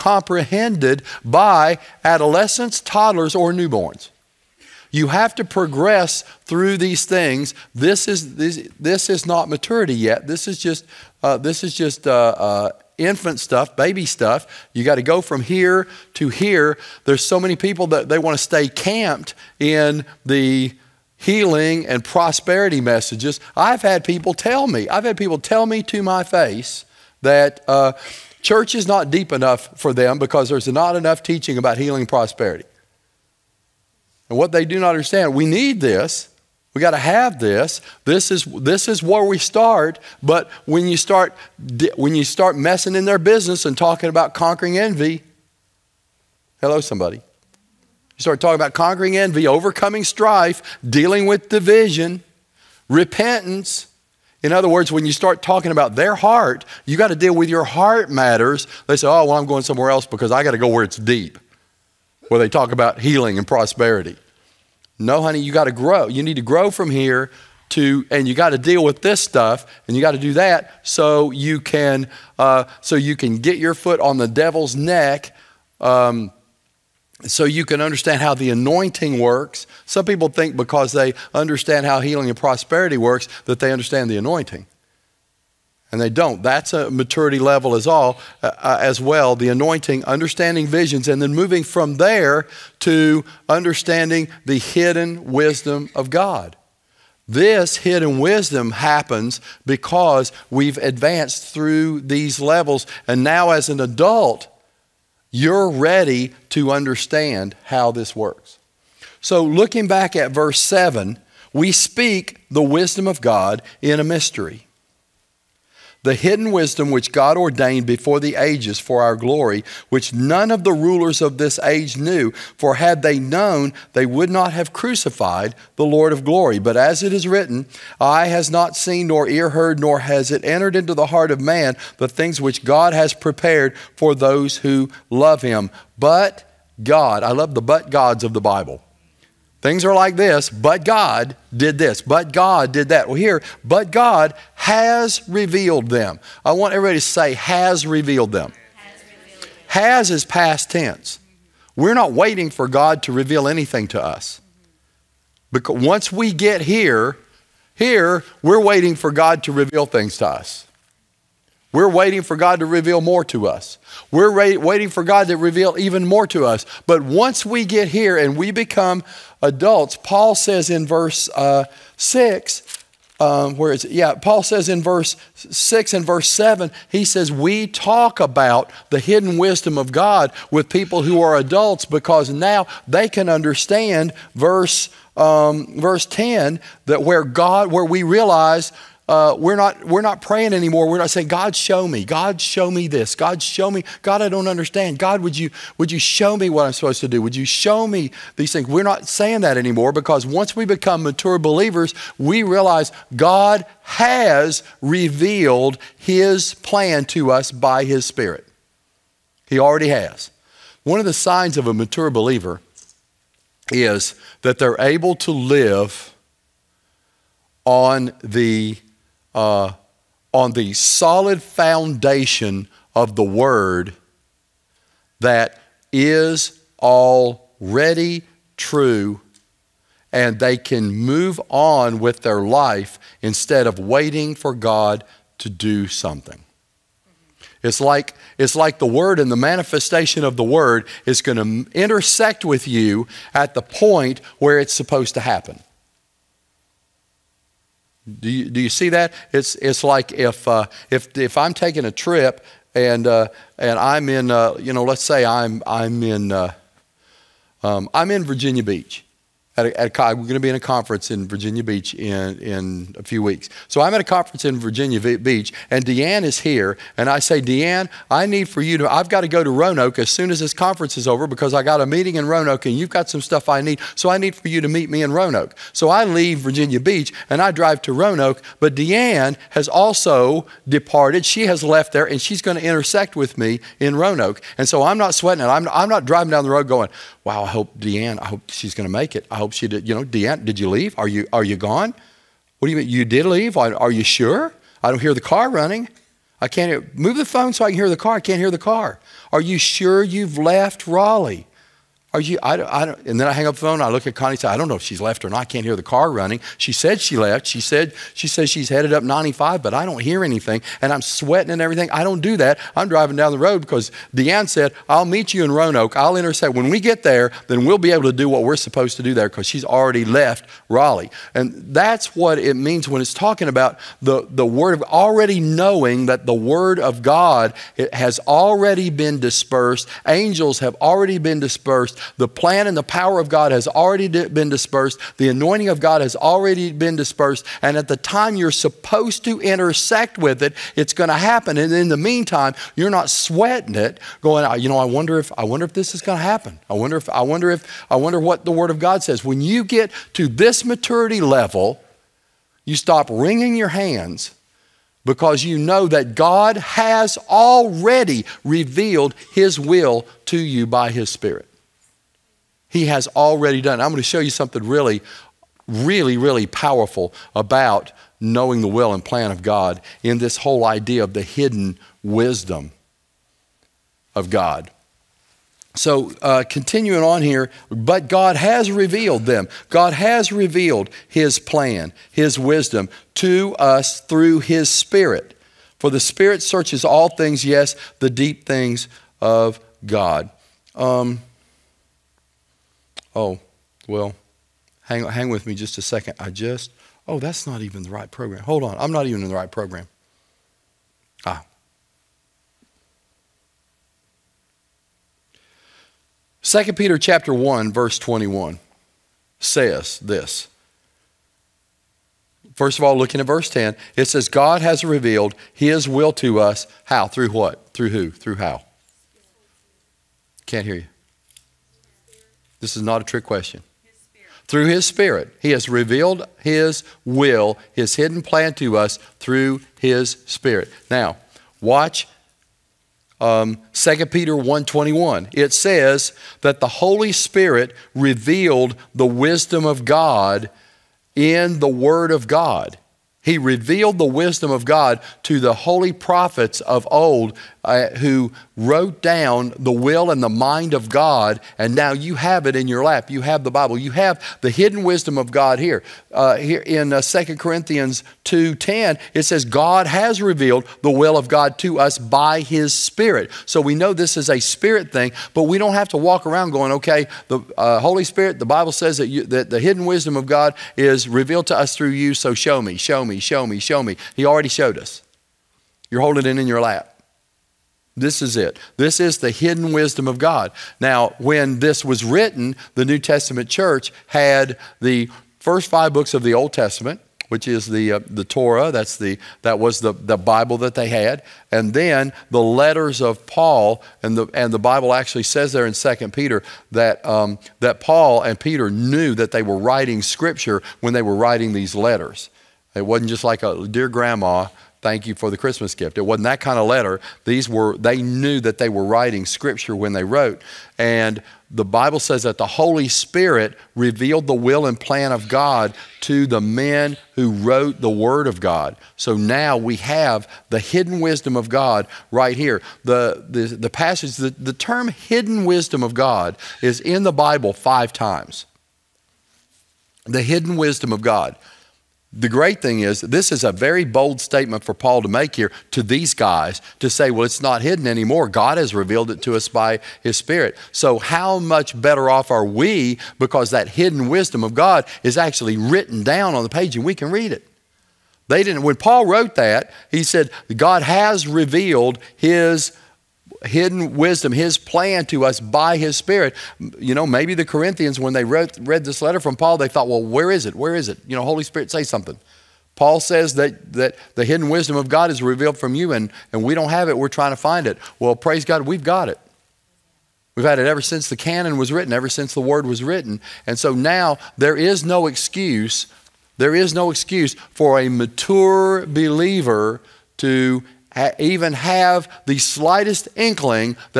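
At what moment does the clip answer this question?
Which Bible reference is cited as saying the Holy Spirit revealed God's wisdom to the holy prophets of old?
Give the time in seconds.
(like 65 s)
433 s.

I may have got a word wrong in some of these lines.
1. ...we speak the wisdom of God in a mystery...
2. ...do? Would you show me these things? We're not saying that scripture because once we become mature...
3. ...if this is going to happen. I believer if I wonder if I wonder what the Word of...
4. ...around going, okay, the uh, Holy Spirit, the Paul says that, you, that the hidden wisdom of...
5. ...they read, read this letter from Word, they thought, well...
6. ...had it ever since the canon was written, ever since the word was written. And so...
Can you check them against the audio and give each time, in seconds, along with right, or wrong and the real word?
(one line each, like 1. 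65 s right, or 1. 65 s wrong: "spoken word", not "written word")
1. 111 s right
2. 197 s wrong: "anymore", not "scripture"
3. 345 s wrong: "wonder", not "believer"
4. 466 s wrong: "Bible", not "Paul"
5. 558 s wrong: "Paul", not "Word"
6. 570 s right.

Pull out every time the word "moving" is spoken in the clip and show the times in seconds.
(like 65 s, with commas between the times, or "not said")
91 s.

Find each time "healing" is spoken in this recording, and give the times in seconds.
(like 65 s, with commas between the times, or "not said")
21 s, 31 s, 63 s, 82 s.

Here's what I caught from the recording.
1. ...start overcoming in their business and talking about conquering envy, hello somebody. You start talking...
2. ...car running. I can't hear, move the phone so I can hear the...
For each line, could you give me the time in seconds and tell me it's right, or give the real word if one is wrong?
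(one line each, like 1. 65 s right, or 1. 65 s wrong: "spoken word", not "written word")
1. 42 s wrong: "messing", not "overcoming"
2. 295 s right.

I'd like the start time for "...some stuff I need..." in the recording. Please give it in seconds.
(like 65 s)
273 s.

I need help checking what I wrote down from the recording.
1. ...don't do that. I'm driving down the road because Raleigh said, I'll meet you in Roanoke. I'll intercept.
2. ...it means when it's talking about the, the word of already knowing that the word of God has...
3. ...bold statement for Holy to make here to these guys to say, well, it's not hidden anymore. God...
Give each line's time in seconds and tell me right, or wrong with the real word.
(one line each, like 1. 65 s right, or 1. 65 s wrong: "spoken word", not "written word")
1. 312 s wrong: "Deanne", not "Raleigh"
2. 322 s right
3. 533 s wrong: "Paul", not "Holy".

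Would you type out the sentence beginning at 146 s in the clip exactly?
I want everybody to say, has revealed them.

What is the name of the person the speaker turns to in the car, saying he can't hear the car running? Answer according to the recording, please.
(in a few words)
Connie.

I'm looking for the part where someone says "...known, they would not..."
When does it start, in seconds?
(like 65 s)
123 s.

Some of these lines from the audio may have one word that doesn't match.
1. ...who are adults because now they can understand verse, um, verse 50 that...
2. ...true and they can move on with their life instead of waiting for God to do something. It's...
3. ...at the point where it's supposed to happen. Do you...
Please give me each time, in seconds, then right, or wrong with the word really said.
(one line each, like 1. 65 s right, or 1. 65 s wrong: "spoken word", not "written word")
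1. 181 s wrong: "10", not "50"
2. 228 s right
3. 243 s right.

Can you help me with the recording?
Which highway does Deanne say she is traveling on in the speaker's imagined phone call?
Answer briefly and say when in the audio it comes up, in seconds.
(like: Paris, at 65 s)
95, at 309 s.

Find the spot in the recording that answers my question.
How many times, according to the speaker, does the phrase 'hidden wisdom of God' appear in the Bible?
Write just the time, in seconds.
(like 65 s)
527 s.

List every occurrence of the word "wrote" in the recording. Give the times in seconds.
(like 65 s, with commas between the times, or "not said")
448 s, 510 s, 517 s, 549 s.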